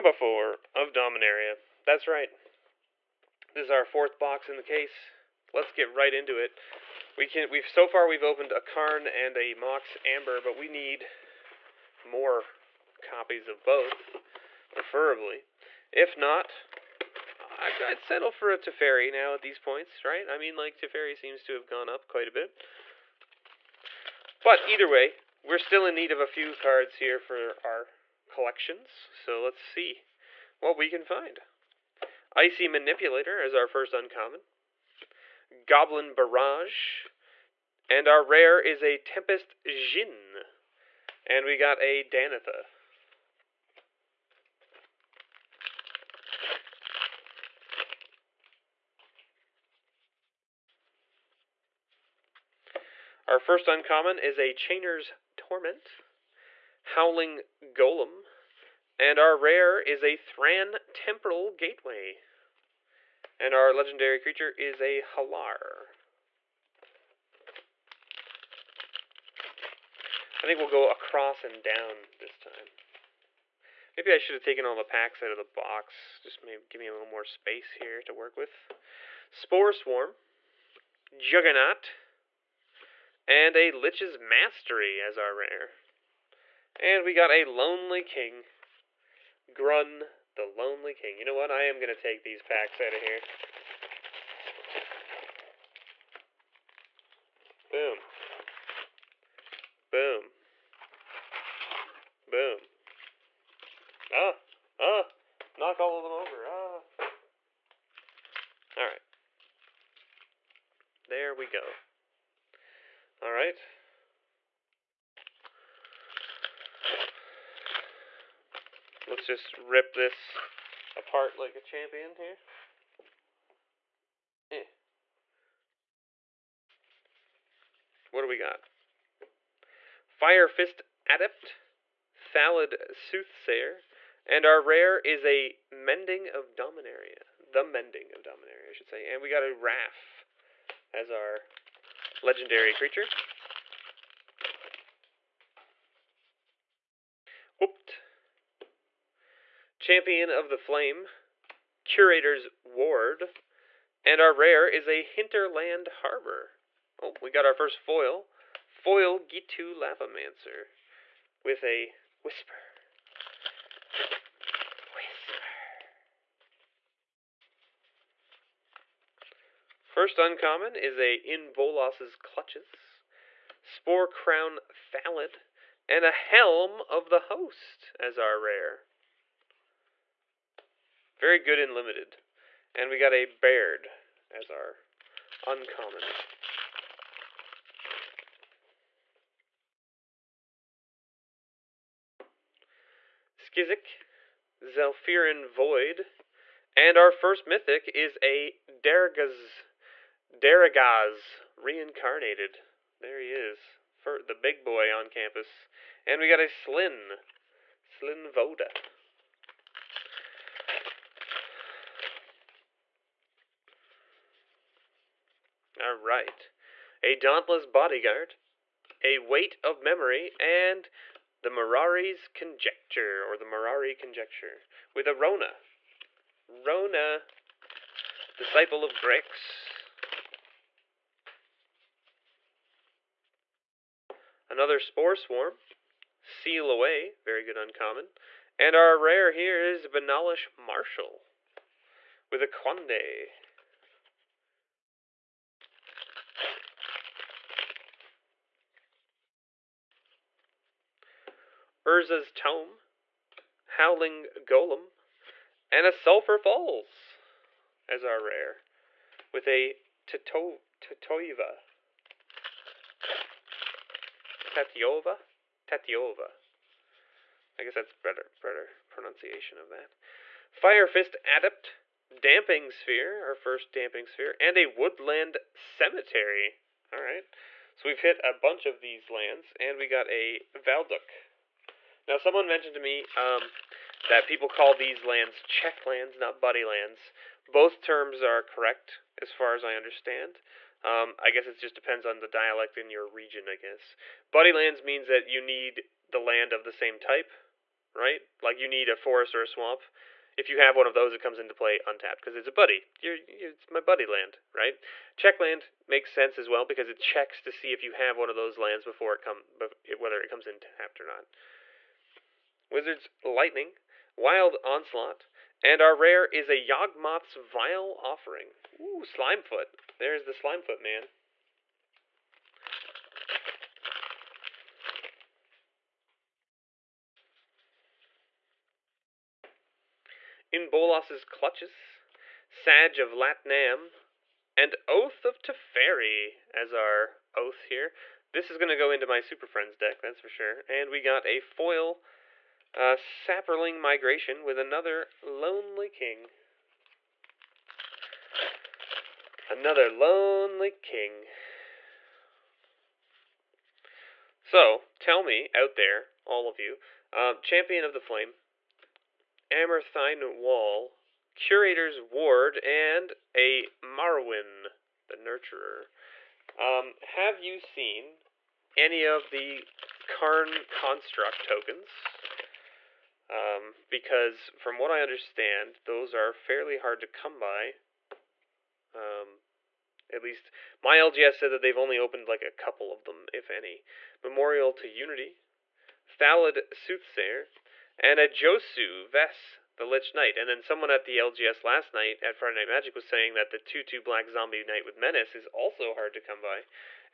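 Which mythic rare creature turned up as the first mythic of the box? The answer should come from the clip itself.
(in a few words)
Darigaaz Reincarnated.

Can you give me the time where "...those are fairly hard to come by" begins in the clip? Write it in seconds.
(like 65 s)
375 s.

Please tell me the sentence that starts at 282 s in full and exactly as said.
Now, someone mentioned to me um, that people call these lands check lands, not buddy lands.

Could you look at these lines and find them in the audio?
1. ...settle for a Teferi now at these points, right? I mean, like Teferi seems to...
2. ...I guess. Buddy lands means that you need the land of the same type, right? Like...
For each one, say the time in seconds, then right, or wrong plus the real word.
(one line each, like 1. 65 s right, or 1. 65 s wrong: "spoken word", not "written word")
1. 17 s right
2. 293 s right.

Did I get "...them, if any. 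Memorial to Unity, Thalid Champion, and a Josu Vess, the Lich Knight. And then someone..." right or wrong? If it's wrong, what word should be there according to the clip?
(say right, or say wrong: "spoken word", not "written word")
wrong: "Soothsayer", not "Champion".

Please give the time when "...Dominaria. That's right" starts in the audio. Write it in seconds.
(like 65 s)
0 s.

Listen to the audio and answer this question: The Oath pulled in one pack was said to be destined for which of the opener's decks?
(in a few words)
Super Friends.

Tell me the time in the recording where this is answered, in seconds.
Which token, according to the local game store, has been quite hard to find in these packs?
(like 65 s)
370 s.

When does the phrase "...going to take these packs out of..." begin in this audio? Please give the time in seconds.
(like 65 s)
91 s.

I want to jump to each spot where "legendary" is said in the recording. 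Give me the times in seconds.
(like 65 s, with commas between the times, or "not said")
63 s, 142 s.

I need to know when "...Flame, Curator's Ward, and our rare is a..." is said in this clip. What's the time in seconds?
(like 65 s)
150 s.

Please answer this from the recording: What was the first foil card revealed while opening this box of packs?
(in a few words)
Ghitu Lavamancer.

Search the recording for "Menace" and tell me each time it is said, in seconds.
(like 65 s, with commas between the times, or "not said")
394 s.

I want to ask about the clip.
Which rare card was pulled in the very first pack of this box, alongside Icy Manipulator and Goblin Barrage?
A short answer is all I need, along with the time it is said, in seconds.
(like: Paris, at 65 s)
Tempest Djinn, at 38 s.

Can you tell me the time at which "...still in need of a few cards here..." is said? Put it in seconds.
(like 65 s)
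25 s.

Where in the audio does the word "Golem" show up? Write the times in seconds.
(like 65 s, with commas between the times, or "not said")
57 s, 254 s.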